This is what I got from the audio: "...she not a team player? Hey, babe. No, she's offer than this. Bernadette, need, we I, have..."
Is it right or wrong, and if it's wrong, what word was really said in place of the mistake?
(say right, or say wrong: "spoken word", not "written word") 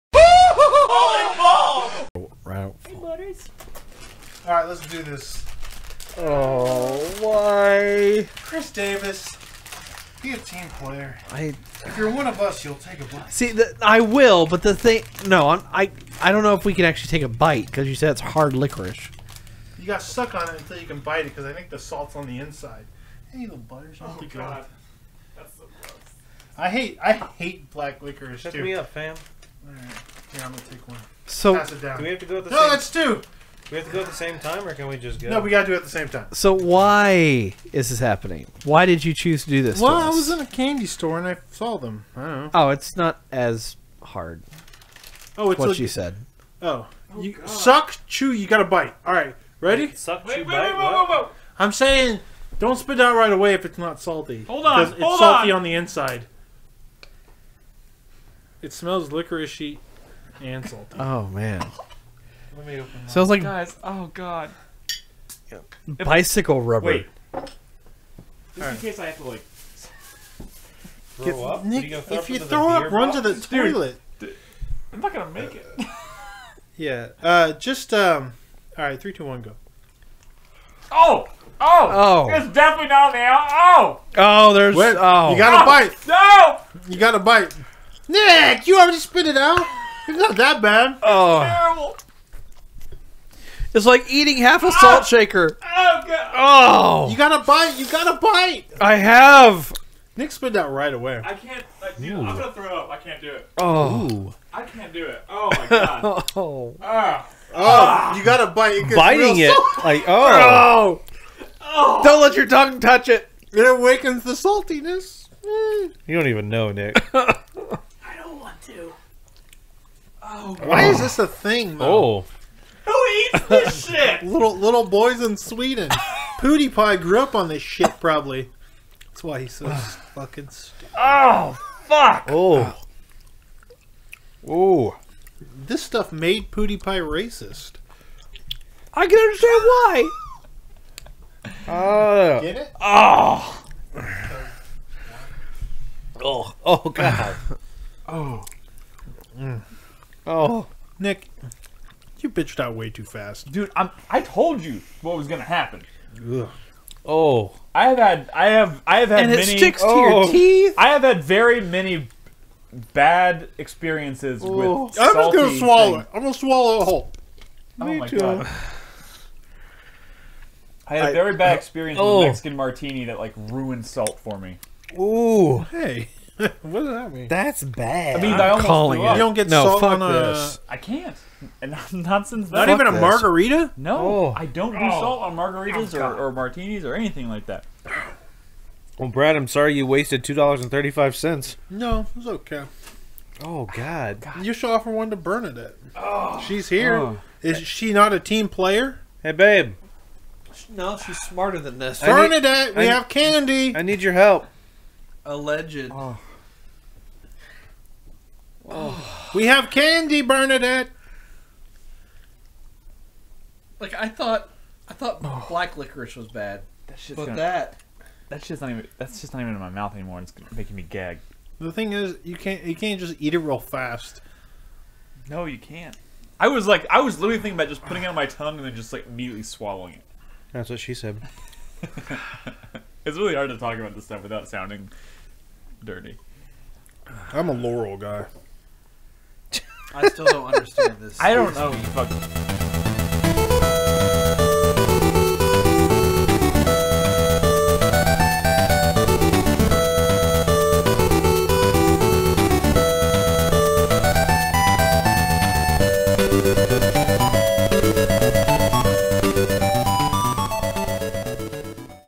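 wrong: "smarter", not "offer".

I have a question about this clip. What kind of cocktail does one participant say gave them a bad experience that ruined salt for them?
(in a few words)
Mexican martini.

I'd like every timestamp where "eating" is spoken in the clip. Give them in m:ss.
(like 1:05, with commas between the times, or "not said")
1:34.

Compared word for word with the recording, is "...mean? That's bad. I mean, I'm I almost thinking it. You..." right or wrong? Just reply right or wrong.
wrong.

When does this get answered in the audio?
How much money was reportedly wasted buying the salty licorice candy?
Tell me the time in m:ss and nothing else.
3:10.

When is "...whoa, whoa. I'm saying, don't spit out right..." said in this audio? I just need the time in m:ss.
0:51.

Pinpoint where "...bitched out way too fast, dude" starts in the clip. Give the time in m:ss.
2:32.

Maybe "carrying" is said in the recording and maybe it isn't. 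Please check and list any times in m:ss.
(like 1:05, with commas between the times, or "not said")
not said.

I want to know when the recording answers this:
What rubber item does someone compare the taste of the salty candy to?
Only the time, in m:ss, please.
1:06.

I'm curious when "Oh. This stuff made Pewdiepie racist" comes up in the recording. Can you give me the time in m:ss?
2:14.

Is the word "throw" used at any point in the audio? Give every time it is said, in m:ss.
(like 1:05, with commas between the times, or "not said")
1:12, 1:42.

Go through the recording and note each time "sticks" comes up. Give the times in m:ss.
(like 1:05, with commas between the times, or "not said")
2:39.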